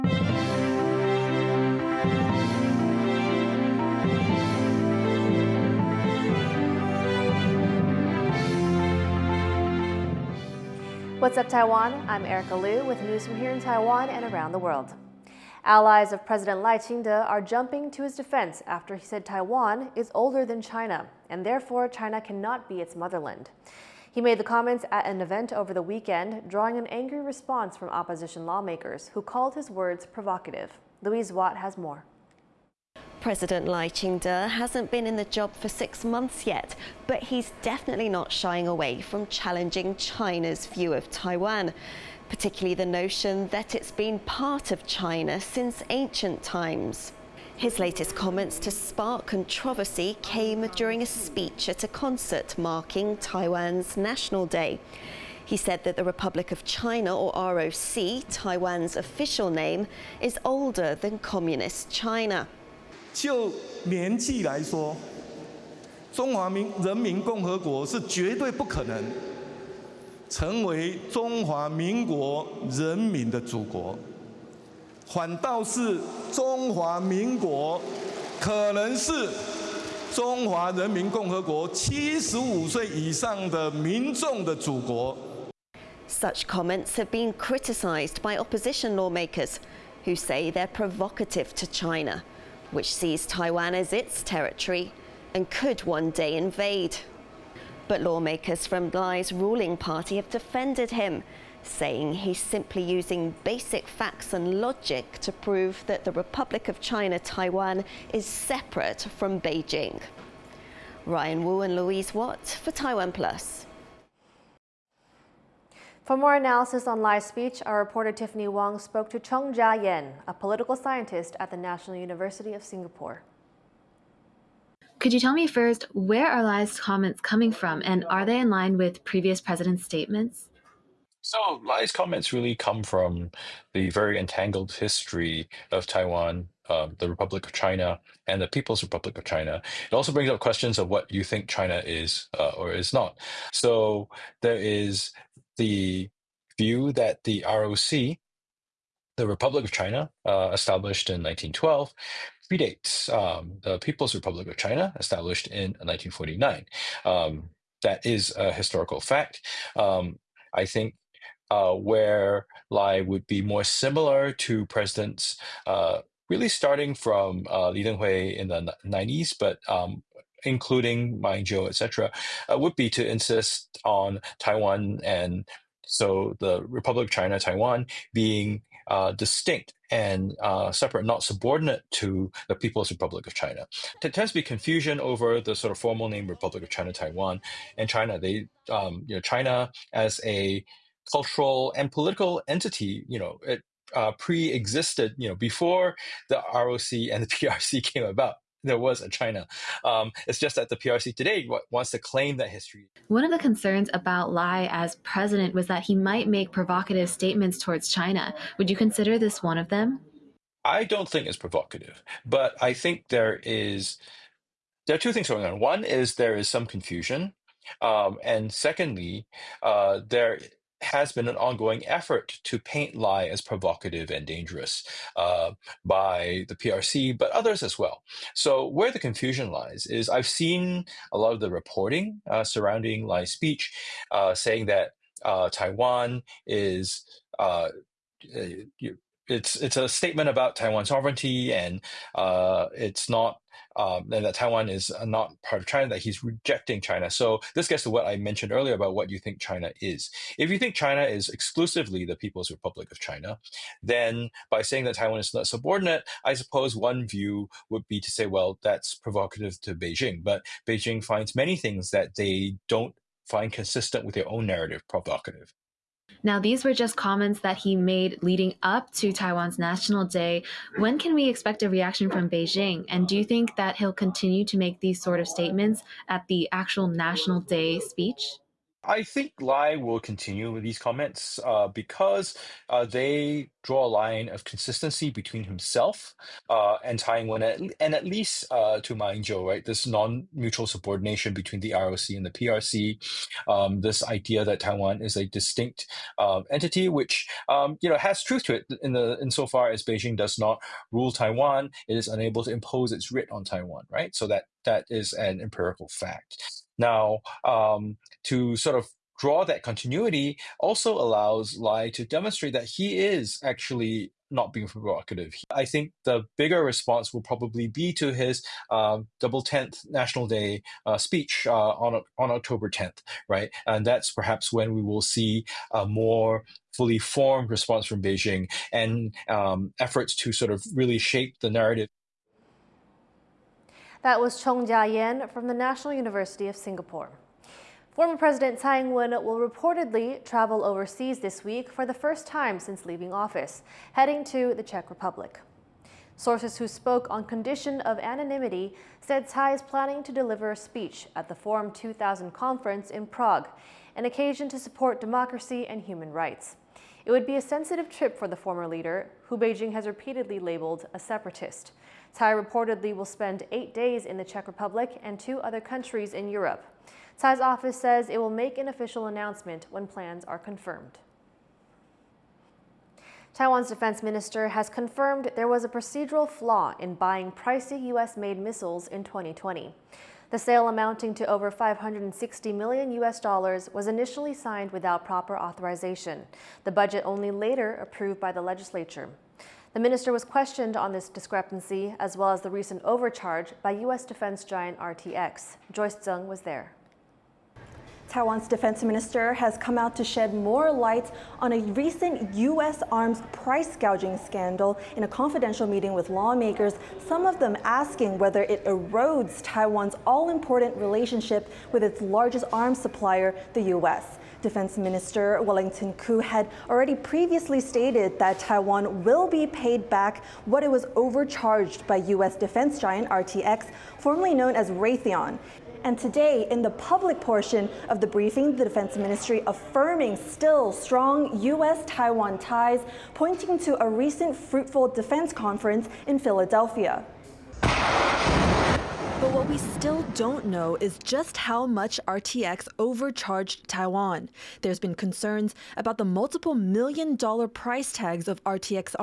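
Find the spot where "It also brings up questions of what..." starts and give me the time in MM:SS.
02:19.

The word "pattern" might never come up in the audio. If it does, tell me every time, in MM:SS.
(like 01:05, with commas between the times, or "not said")
not said.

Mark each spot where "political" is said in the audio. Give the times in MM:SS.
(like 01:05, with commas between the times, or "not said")
02:00, 03:11.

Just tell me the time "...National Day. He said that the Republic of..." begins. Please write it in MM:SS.
00:53.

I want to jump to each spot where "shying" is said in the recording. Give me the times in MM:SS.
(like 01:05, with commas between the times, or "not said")
00:38.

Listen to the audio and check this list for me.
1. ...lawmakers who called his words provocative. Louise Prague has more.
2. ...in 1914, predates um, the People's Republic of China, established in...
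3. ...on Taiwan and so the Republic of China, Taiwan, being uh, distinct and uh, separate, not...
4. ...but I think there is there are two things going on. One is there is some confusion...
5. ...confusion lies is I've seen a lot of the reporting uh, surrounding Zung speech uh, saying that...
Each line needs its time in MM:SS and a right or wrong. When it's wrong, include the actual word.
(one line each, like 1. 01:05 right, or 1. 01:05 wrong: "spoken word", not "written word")
1. 00:28 wrong: "Watt", not "Prague"
2. 02:31 wrong: "1912", not "1914"
3. 02:53 right
4. 03:32 right
5. 03:48 wrong: "Lai", not "Zung".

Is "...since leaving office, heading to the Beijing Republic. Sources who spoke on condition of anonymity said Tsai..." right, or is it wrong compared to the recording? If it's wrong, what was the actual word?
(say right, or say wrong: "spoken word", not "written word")
wrong: "Czech", not "Beijing".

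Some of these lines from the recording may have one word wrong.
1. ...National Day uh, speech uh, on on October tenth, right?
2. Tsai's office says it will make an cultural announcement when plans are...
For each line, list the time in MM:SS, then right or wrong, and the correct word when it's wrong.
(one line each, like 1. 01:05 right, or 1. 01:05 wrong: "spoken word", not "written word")
1. 05:19 right
2. 06:07 wrong: "official", not "cultural".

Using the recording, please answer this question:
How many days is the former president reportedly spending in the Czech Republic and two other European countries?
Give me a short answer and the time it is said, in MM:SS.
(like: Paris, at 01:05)
8, at 06:03.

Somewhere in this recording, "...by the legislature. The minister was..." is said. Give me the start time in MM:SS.
06:28.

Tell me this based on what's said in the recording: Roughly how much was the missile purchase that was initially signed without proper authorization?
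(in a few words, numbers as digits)
over 560 million US dollars.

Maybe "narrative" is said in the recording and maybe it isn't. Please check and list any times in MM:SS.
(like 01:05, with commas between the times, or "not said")
04:24, 05:31.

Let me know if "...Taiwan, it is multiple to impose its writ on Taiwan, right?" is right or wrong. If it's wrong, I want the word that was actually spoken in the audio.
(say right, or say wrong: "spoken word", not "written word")
wrong: "unable", not "multiple".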